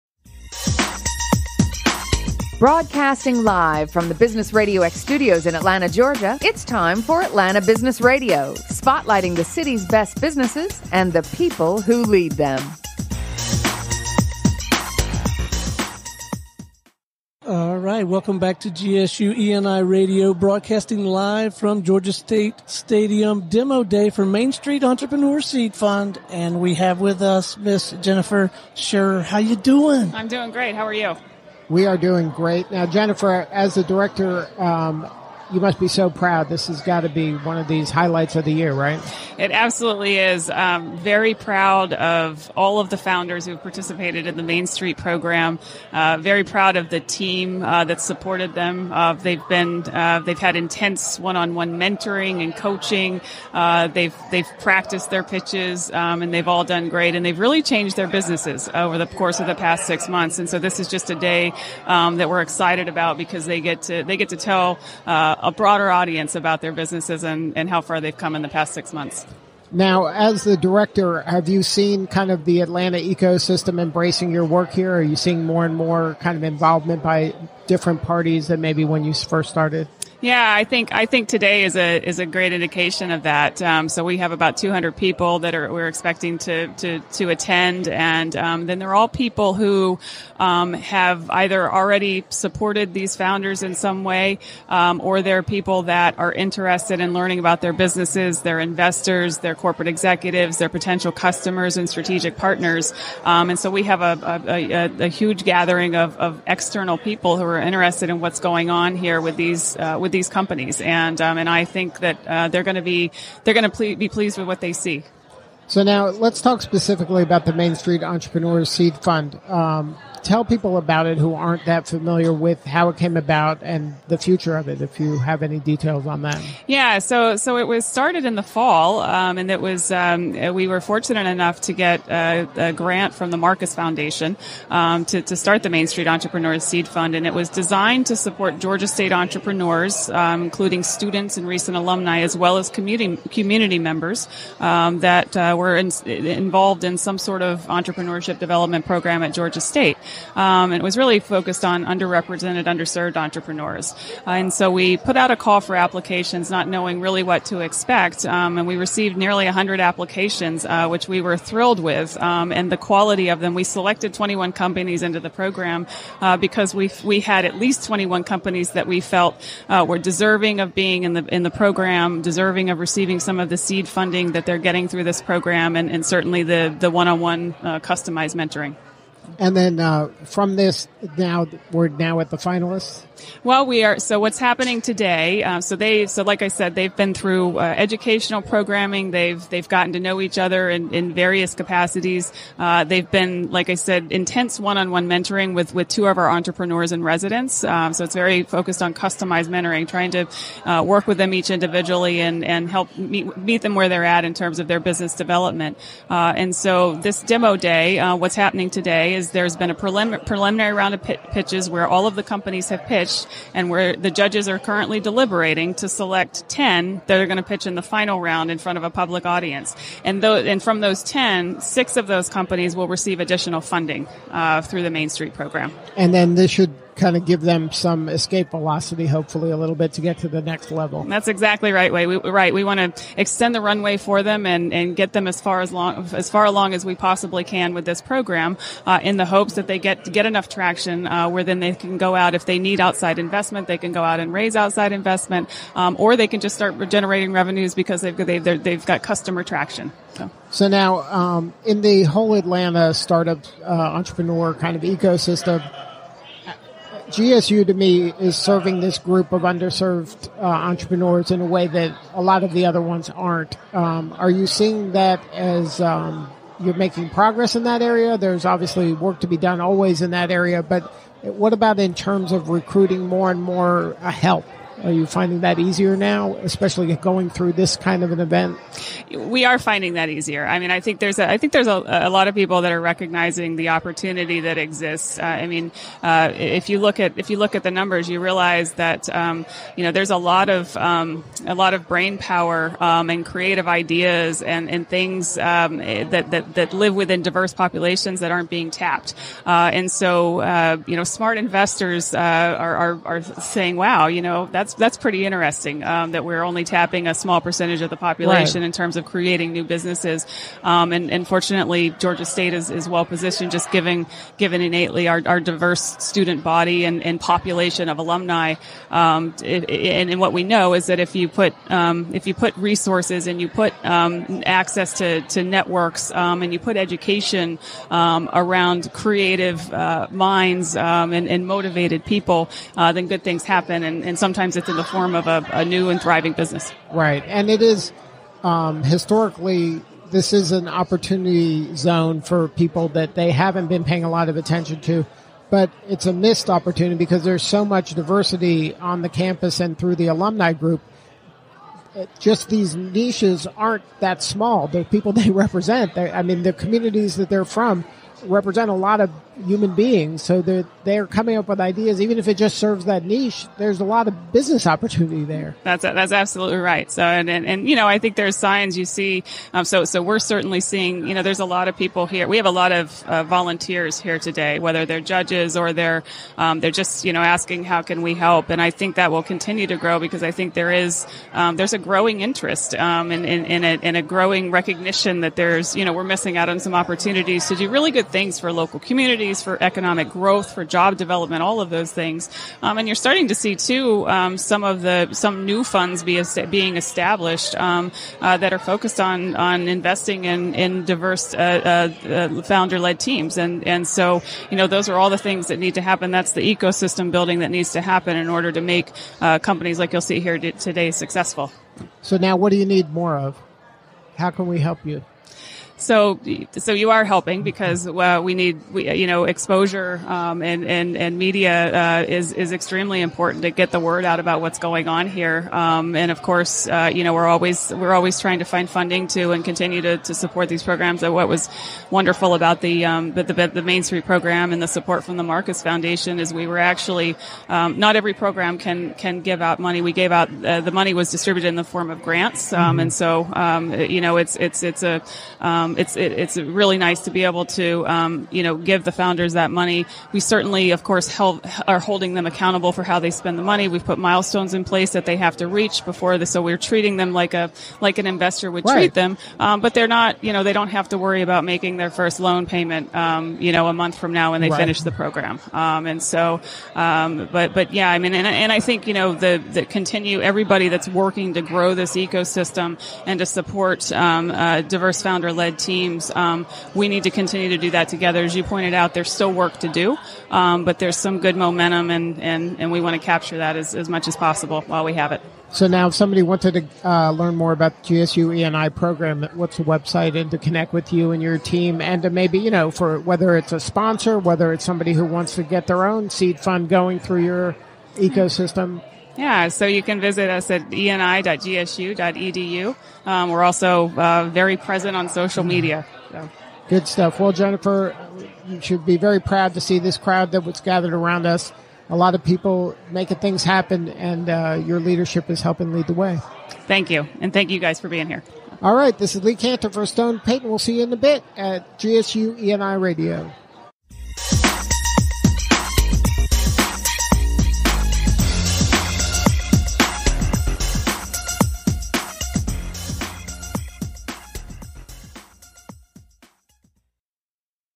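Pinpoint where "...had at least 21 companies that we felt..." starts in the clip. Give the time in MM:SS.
02:47.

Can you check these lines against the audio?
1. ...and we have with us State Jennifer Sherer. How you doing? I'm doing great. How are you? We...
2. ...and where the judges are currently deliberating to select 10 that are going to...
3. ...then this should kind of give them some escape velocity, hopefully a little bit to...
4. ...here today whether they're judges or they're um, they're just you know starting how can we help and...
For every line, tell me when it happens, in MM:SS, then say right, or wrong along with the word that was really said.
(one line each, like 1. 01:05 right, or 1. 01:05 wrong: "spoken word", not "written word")
1. 00:26 wrong: "Miss", not "State"
2. 03:33 right
3. 03:46 right
4. 06:13 wrong: "asking", not "starting".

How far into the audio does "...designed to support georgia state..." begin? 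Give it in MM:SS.
02:17.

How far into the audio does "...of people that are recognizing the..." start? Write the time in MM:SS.
04:42.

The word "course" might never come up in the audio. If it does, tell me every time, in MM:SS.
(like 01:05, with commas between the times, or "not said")
00:59, 07:06, 07:30.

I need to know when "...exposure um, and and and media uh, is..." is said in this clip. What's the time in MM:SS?
06:59.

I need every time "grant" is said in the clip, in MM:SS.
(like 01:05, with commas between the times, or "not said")
02:12, 07:22.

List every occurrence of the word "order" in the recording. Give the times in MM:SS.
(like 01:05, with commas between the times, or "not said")
06:48.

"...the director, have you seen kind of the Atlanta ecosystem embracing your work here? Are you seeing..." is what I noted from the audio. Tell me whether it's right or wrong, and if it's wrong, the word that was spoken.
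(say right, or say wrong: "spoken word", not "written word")
right.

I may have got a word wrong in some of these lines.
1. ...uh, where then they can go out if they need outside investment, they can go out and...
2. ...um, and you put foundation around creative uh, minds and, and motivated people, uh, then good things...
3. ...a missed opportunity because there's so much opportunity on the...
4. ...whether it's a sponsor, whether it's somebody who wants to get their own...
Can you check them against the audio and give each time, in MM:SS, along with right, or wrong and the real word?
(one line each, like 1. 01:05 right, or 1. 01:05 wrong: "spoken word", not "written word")
1. 04:01 right
2. 05:26 wrong: "education", not "foundation"
3. 05:46 wrong: "diversity", not "opportunity"
4. 08:13 right.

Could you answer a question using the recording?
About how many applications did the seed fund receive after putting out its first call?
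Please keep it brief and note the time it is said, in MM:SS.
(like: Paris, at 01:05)
nearly 100, at 02:39.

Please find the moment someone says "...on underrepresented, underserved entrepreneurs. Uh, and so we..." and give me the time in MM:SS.
02:31.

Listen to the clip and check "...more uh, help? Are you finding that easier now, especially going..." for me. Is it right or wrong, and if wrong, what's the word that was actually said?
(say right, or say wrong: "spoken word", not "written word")
right.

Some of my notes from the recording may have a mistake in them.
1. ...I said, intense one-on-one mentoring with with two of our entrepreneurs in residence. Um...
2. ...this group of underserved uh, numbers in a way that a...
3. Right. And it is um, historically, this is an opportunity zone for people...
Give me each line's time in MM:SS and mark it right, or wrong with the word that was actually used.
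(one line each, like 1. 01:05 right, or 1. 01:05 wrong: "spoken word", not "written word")
1. 03:13 right
2. 04:18 wrong: "entrepreneurs", not "numbers"
3. 05:36 right.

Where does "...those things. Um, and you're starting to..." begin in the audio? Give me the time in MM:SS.
06:31.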